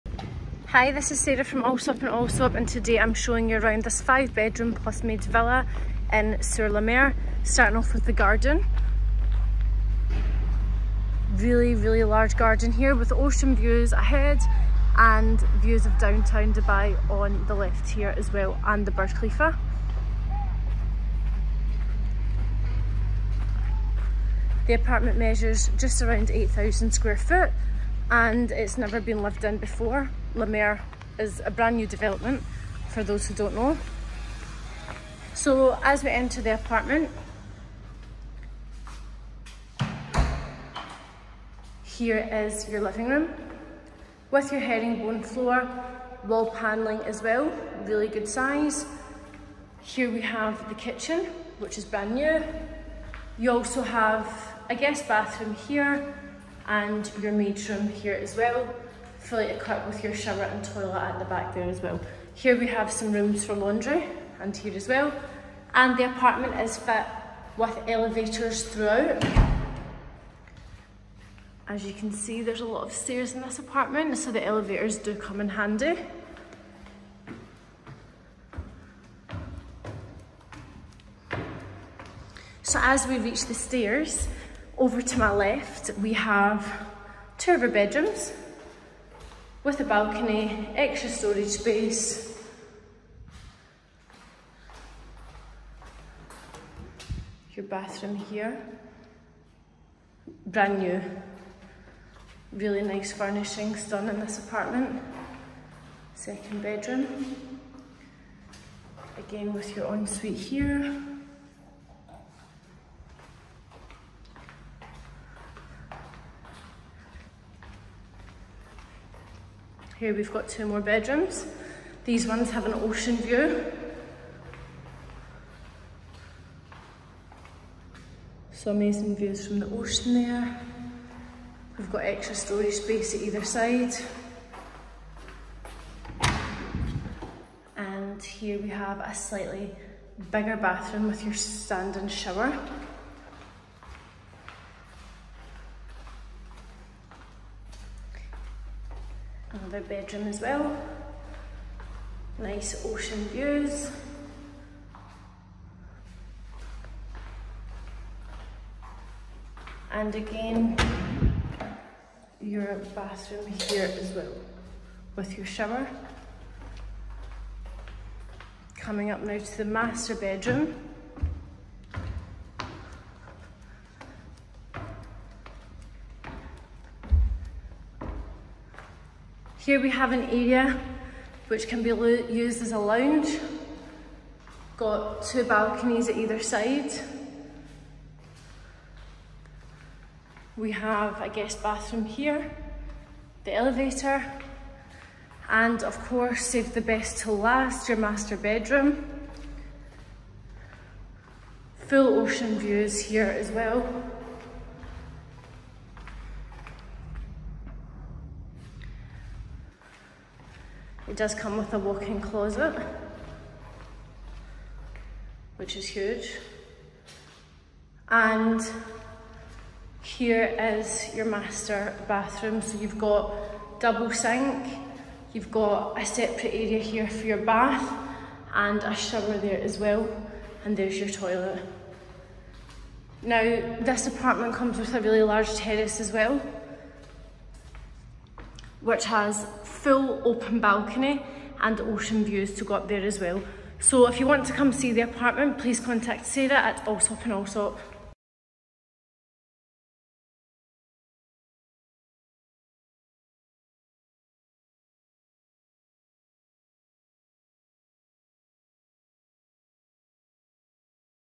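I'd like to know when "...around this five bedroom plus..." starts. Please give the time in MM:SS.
00:03.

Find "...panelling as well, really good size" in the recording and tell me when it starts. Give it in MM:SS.
00:46.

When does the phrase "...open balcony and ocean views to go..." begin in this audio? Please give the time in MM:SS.
04:00.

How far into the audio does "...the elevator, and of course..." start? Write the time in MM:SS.
03:13.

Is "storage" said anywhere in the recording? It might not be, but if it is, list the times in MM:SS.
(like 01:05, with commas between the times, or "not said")
01:31, 02:12.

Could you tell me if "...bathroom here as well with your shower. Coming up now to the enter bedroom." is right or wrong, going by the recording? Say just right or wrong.
wrong.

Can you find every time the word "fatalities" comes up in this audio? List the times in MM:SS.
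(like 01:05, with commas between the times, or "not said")
not said.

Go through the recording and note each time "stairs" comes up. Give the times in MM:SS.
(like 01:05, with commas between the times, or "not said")
01:12, 01:23.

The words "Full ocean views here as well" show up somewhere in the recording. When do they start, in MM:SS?
03:21.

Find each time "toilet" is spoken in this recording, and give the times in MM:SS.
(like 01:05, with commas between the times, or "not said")
01:00, 03:51.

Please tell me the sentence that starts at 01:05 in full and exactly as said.
And the apartment is fit with elevators throughout.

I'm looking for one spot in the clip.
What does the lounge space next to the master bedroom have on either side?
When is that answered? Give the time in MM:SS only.
03:05.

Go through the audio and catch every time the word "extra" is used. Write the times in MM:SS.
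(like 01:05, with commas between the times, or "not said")
01:30, 02:11.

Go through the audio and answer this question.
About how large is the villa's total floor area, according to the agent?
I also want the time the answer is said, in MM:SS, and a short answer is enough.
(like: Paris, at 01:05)
8,000 square feet, at 00:26.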